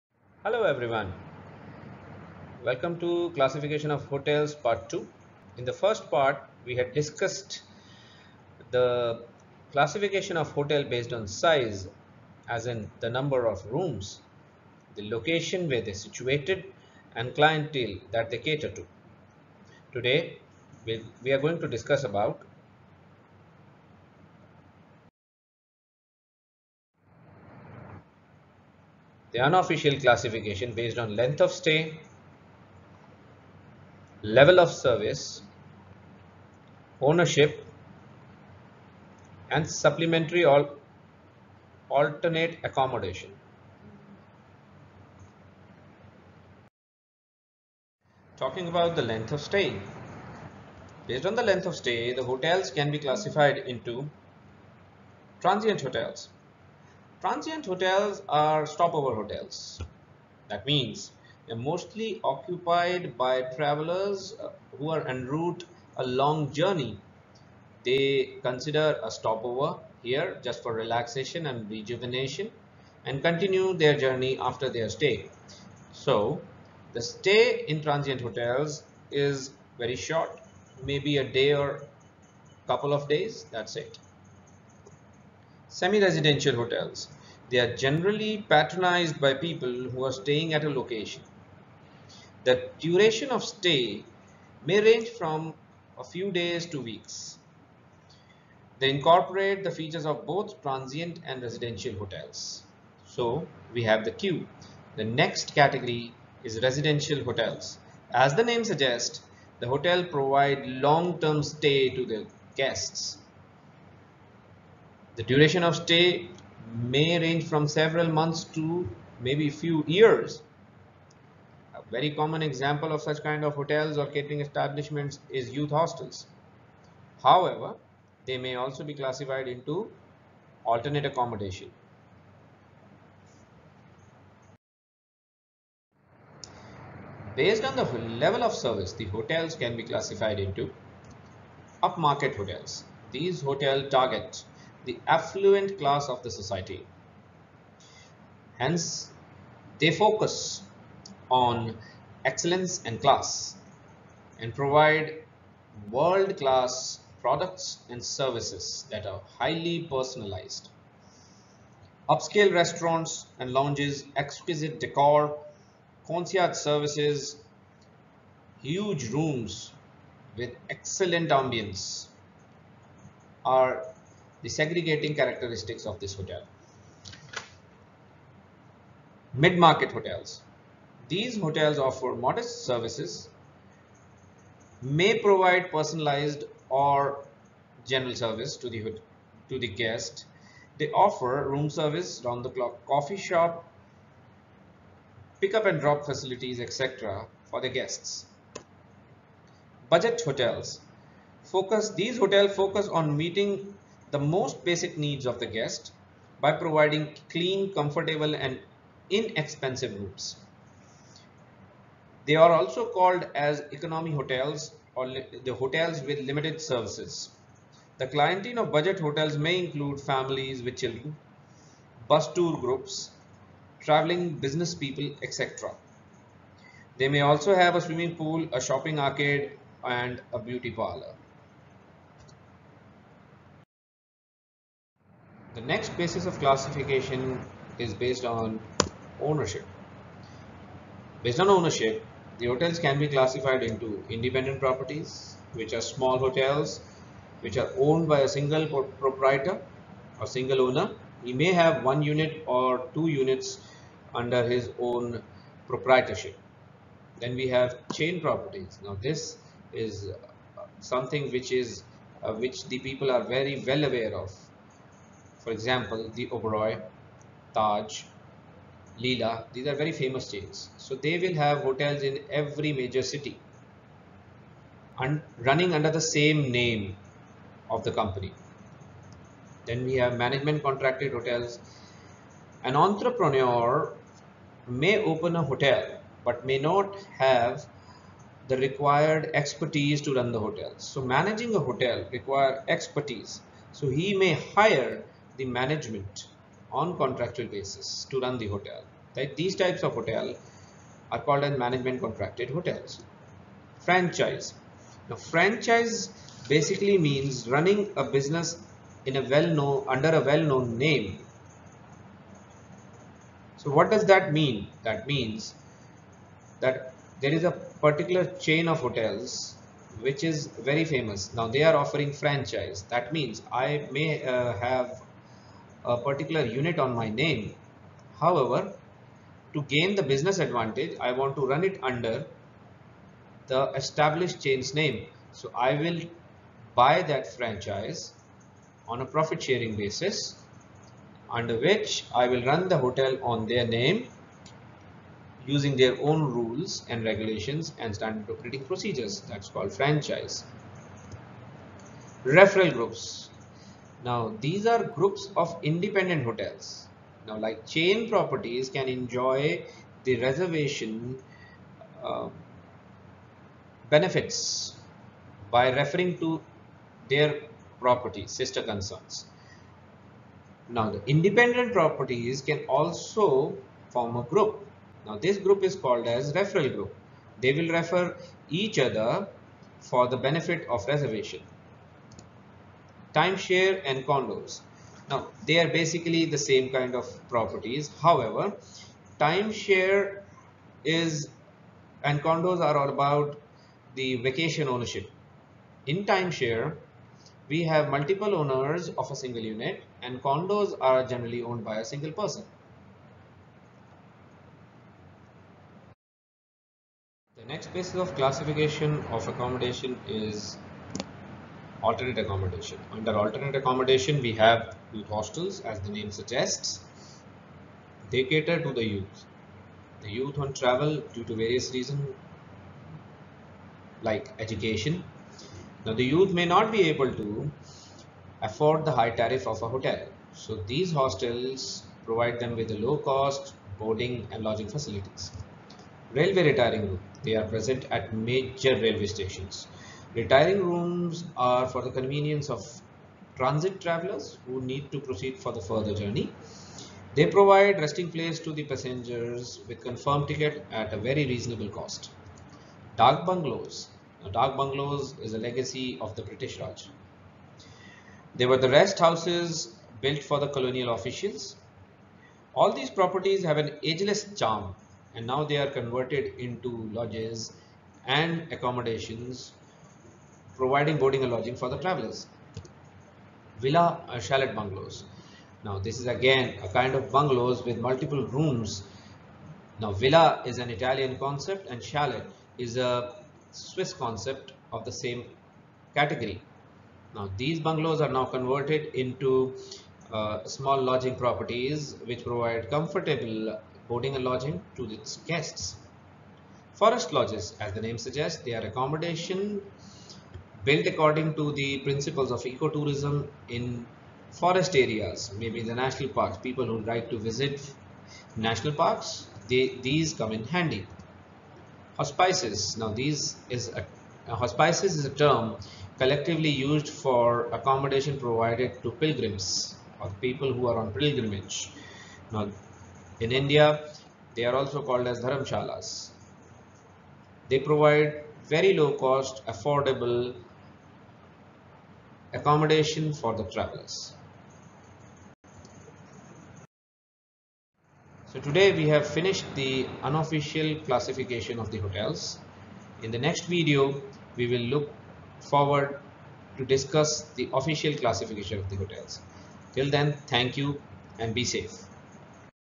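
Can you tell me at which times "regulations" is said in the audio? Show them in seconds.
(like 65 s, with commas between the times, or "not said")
347 s.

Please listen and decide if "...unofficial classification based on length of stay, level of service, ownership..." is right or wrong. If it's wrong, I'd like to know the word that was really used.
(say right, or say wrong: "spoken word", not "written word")
right.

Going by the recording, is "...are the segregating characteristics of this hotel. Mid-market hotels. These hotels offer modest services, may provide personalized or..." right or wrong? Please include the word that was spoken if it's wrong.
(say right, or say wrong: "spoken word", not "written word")
right.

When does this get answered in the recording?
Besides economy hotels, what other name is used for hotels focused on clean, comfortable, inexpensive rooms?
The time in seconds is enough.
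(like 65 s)
215 s.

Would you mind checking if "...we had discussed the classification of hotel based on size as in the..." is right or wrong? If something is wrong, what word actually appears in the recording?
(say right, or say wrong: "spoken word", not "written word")
right.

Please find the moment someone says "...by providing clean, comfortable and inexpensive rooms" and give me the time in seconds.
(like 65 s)
206 s.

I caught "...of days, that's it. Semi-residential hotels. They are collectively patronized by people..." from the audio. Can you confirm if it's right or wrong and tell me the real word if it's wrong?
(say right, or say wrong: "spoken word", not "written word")
wrong: "generally", not "collectively".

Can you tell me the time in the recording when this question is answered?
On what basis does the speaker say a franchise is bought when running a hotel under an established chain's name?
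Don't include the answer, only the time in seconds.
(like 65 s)
339 s.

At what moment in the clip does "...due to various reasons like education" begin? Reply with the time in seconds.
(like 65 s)
421 s.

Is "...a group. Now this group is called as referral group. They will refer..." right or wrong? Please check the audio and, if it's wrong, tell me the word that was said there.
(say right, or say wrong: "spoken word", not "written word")
right.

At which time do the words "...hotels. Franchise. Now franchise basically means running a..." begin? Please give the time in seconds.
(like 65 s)
302 s.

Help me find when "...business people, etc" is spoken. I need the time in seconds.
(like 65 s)
224 s.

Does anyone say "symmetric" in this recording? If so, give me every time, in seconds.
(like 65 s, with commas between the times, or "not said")
not said.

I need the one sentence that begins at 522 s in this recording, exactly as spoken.
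Now, in India, they are also called as dharamshalas.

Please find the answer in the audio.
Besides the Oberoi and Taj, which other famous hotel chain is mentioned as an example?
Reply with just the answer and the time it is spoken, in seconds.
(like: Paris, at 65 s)
Leela, at 268 s.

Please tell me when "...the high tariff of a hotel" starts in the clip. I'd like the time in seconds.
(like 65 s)
428 s.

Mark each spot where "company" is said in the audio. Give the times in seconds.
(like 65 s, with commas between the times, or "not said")
277 s.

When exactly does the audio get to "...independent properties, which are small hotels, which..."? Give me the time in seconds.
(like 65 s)
244 s.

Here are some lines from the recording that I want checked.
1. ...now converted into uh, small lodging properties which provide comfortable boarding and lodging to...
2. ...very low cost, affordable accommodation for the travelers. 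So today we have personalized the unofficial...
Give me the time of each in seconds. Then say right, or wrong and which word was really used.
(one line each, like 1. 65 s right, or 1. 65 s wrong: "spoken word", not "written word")
1. 488 s right
2. 528 s wrong: "finished", not "personalized".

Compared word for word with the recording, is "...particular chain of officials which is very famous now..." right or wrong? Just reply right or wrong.
wrong.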